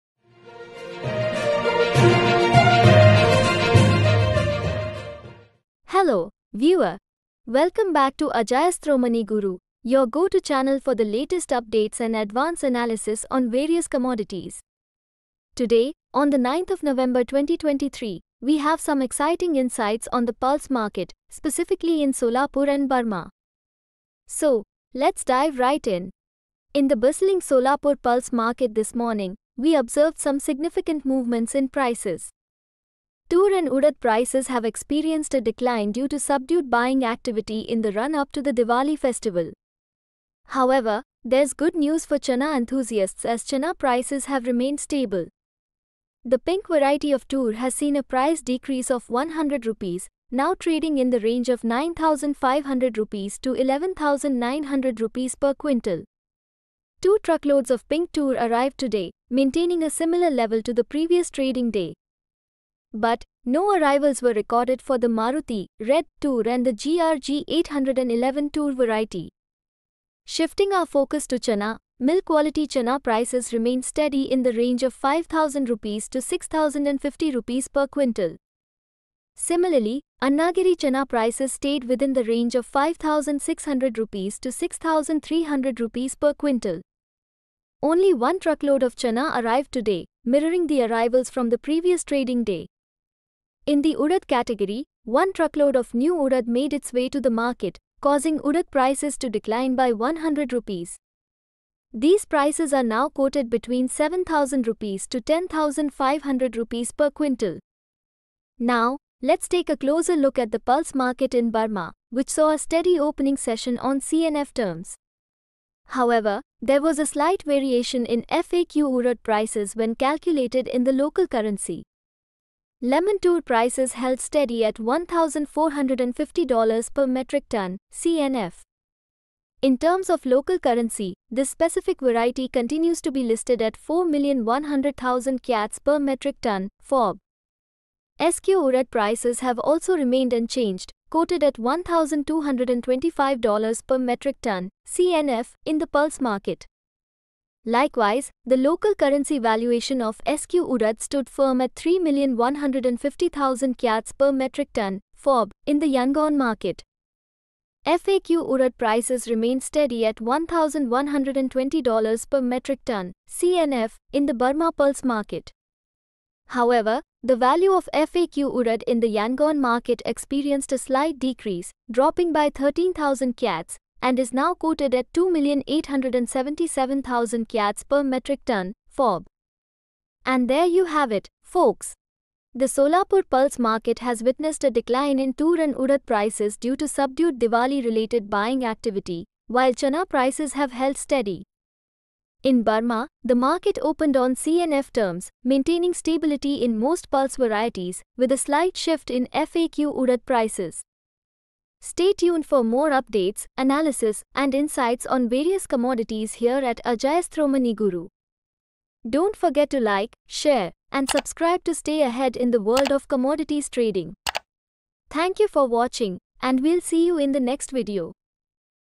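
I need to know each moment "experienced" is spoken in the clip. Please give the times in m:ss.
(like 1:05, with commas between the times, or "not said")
0:34, 2:50.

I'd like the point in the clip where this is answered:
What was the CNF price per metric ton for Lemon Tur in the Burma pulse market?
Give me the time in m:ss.
2:04.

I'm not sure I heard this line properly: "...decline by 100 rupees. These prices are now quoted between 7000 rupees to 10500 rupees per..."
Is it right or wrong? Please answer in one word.
right.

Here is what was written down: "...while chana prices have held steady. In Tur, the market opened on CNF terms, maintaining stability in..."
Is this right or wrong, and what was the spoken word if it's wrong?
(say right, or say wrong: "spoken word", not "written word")
wrong: "Burma", not "Tur".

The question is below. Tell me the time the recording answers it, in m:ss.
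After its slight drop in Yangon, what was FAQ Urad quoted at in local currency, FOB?
2:55.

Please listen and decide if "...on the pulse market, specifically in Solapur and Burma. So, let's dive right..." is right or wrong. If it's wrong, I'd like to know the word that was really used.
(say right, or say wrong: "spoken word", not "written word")
right.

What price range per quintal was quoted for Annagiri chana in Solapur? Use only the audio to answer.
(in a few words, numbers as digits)
5600 to 6300 rupees.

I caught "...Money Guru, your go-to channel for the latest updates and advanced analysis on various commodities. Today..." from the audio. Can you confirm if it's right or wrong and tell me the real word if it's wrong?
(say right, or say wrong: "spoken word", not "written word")
right.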